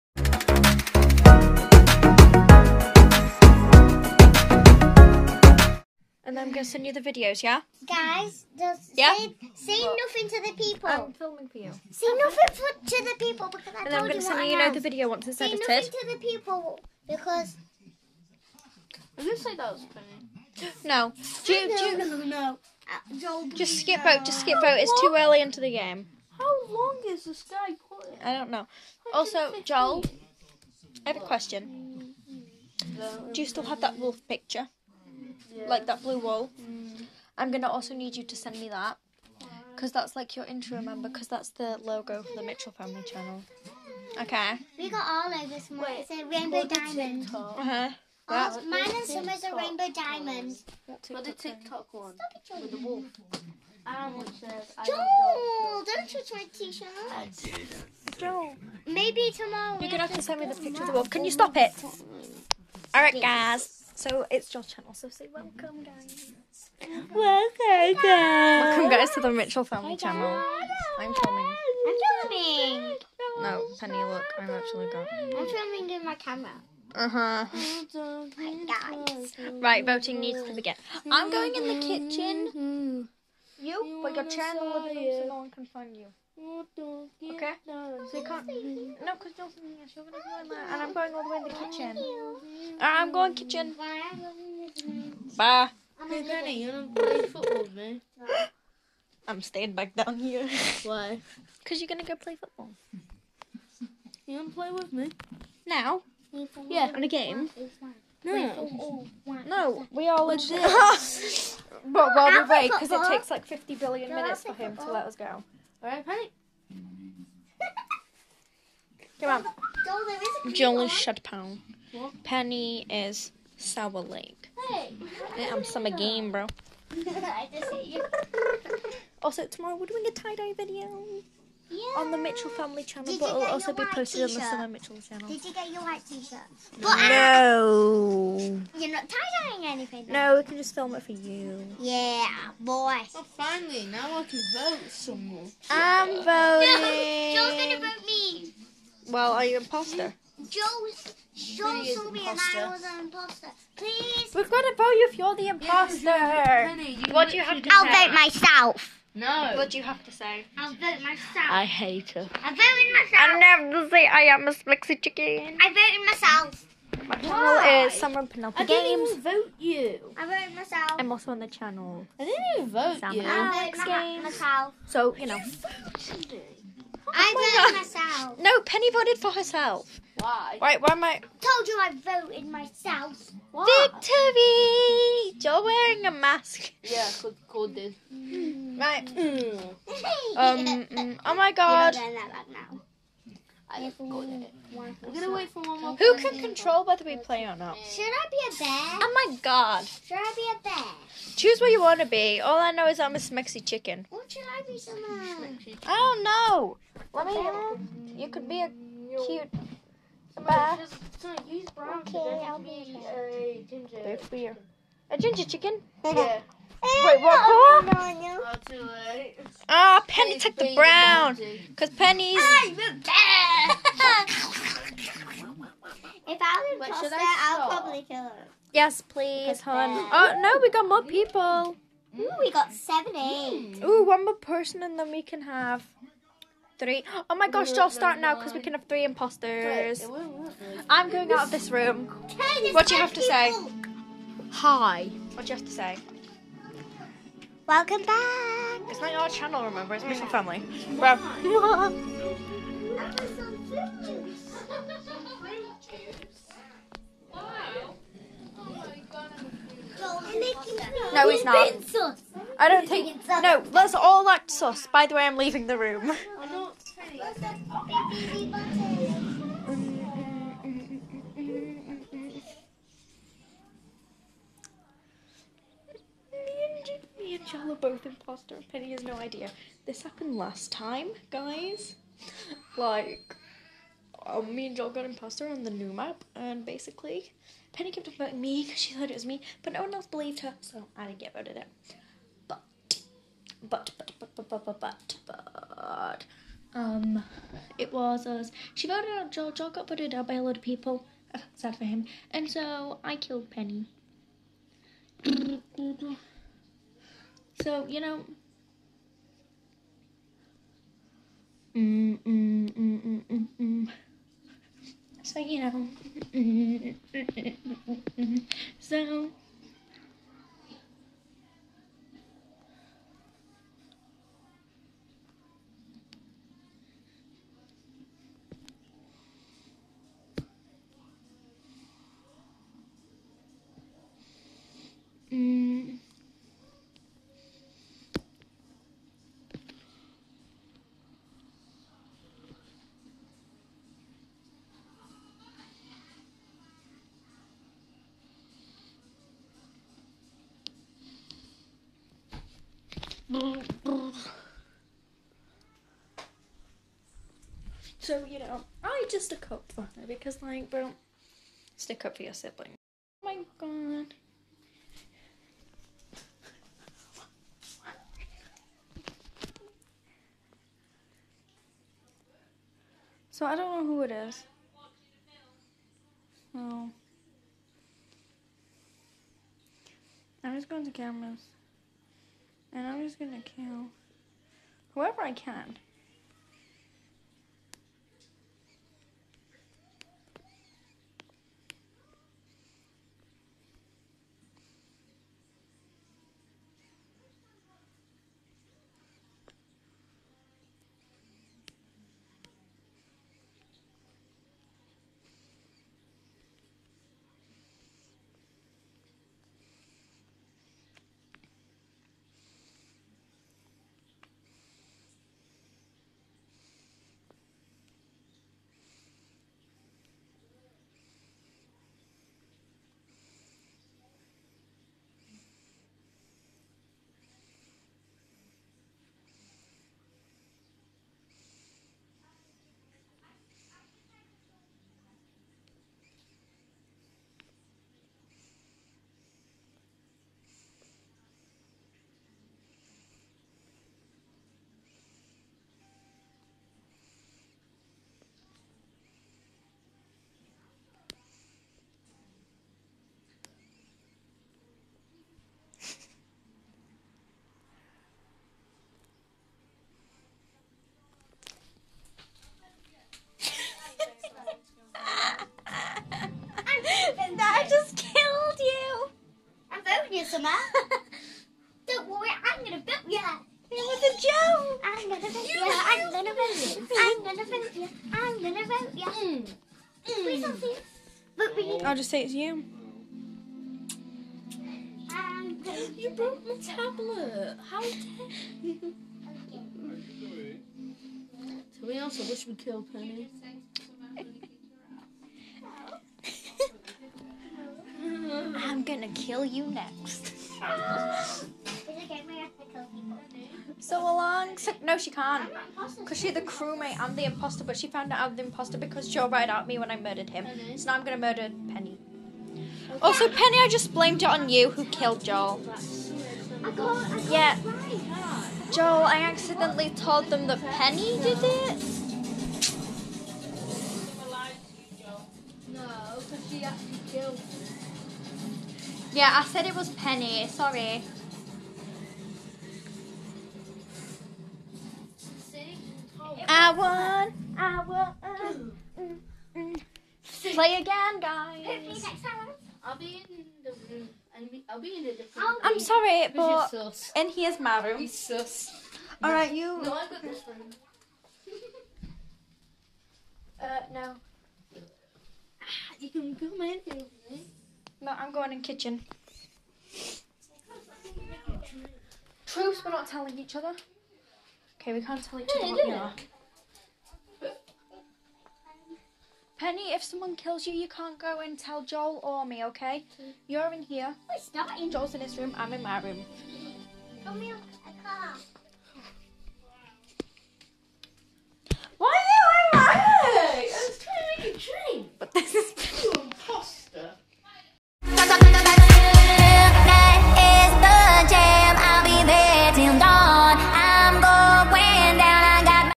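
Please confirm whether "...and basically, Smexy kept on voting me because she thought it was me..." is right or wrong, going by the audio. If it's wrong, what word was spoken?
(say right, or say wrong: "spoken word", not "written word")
wrong: "Penny", not "Smexy".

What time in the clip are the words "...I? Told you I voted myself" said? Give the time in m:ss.
3:01.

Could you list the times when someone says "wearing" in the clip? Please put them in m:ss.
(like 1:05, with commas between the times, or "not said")
3:05.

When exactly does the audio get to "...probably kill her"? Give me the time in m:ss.
3:47.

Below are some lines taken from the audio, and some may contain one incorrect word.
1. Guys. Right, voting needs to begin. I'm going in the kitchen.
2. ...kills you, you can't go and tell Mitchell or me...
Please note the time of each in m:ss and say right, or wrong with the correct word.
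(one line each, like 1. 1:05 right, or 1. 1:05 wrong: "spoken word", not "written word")
1. 1:17 right
2. 9:30 wrong: "Joel", not "Mitchell".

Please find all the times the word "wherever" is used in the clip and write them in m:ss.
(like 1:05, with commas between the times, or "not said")
not said.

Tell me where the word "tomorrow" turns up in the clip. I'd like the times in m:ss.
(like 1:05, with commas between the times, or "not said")
0:59, 2:09.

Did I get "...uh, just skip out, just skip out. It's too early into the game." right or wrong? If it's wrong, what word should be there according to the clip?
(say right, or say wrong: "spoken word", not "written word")
right.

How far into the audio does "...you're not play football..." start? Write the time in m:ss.
1:36.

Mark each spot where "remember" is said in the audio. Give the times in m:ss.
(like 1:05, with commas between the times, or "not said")
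0:40, 4:09.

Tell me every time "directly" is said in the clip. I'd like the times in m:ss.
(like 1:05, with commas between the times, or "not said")
not said.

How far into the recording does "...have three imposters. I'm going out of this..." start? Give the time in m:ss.
3:58.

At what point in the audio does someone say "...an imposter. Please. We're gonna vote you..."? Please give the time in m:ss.
2:32.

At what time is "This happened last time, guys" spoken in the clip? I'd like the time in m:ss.
4:39.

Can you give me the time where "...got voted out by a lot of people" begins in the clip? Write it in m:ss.
4:59.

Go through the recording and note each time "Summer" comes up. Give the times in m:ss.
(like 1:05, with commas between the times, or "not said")
0:49, 2:14, 2:47, 7:50.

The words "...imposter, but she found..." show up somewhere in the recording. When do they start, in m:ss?
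8:27.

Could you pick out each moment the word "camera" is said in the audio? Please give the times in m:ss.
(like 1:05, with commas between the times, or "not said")
1:16, 6:20.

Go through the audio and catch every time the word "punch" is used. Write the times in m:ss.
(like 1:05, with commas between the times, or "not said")
not said.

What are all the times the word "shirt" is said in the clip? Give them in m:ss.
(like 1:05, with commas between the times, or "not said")
0:56, 2:16.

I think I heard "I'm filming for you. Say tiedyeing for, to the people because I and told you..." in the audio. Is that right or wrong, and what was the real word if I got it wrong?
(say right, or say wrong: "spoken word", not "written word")
wrong: "nothing", not "tiedyeing".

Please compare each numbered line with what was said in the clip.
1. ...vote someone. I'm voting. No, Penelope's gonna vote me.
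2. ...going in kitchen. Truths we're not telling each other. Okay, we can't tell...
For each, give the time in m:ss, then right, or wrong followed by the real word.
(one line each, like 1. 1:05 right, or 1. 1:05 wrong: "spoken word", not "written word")
1. 2:24 wrong: "Joel", not "Penelope"
2. 9:18 right.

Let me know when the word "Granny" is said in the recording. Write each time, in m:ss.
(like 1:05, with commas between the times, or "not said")
1:36.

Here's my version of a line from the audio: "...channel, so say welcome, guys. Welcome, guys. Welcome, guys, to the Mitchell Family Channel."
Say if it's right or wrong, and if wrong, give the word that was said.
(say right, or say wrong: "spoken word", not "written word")
right.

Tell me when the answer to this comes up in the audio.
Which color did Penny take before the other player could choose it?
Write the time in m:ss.
3:40.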